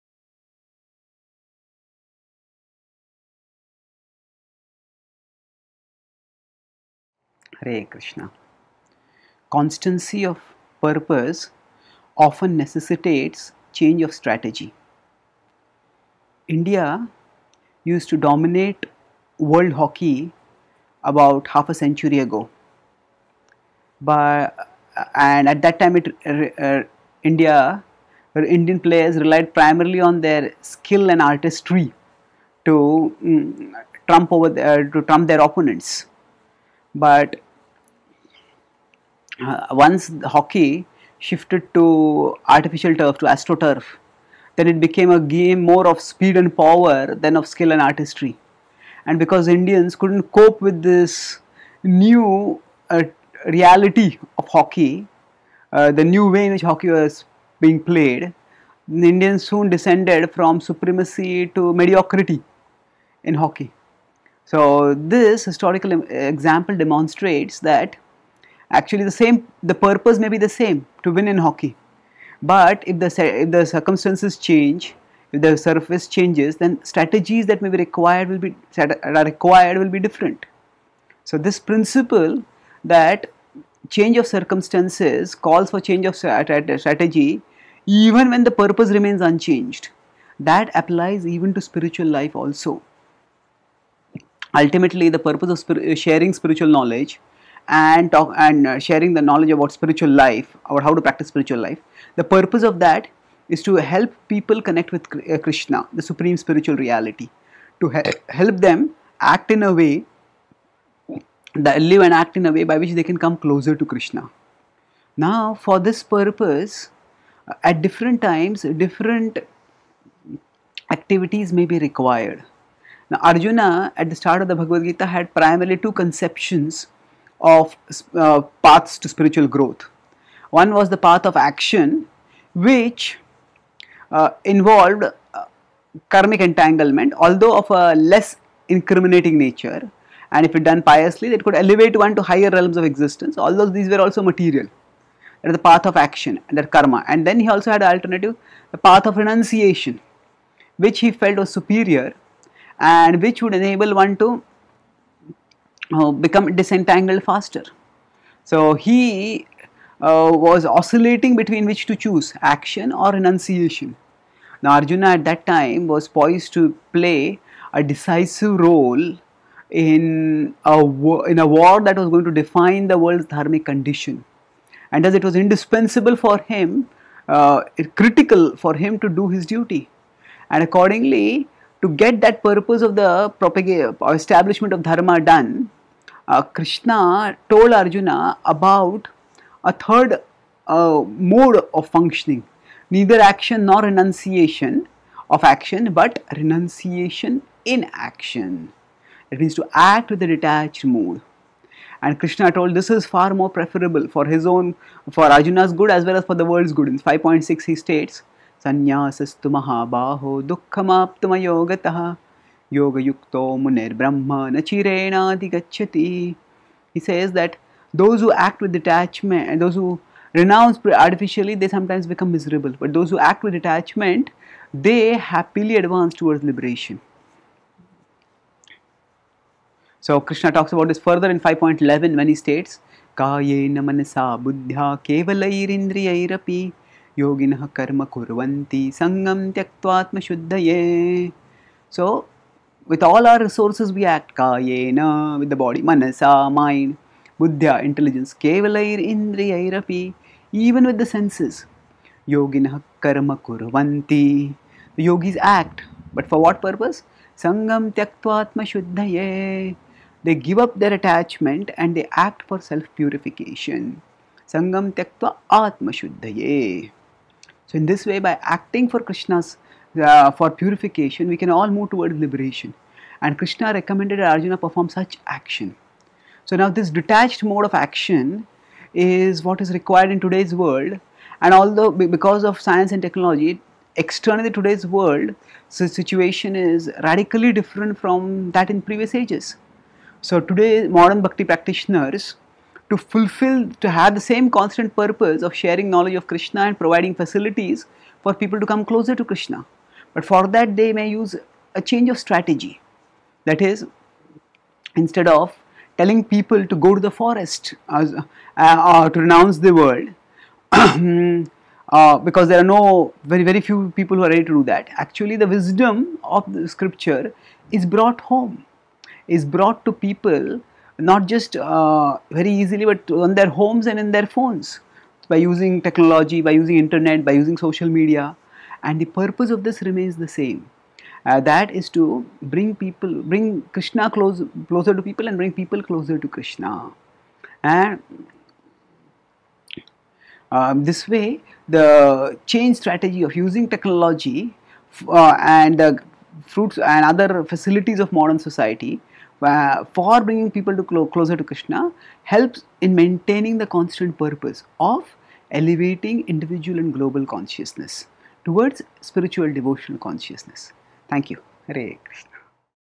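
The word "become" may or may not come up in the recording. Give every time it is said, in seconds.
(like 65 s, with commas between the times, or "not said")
156 s, 222 s.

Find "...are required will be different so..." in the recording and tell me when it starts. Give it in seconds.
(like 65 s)
78 s.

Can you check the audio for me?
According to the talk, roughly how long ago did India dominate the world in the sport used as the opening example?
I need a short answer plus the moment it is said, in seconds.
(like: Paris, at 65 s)
half a century, at 21 s.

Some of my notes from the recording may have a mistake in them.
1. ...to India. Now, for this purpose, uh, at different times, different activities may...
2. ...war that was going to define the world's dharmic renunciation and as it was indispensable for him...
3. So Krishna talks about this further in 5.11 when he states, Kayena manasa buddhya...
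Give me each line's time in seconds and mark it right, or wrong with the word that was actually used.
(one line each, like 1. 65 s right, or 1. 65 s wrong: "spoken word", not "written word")
1. 113 s wrong: "Krishna", not "India"
2. 171 s wrong: "condition", not "renunciation"
3. 229 s right.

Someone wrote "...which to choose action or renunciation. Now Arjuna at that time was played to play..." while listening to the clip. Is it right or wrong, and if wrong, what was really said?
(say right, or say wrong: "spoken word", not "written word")
wrong: "poised", not "played".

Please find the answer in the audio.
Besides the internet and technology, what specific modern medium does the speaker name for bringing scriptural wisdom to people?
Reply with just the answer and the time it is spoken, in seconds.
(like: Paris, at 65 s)
social media, at 327 s.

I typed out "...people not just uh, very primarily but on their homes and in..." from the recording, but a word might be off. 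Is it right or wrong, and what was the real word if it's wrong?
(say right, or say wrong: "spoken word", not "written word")
wrong: "easily", not "primarily".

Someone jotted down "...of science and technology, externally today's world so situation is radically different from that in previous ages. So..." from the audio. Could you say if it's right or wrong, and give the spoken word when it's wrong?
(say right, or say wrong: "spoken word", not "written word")
right.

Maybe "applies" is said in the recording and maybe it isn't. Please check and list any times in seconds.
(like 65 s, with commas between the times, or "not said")
90 s.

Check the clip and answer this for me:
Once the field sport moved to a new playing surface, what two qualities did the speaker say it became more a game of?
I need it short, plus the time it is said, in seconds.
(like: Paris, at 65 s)
speed and power, at 46 s.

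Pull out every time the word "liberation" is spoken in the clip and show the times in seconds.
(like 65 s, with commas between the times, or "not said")
226 s, 272 s.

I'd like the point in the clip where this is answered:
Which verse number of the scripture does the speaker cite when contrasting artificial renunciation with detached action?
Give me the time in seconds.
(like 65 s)
206 s.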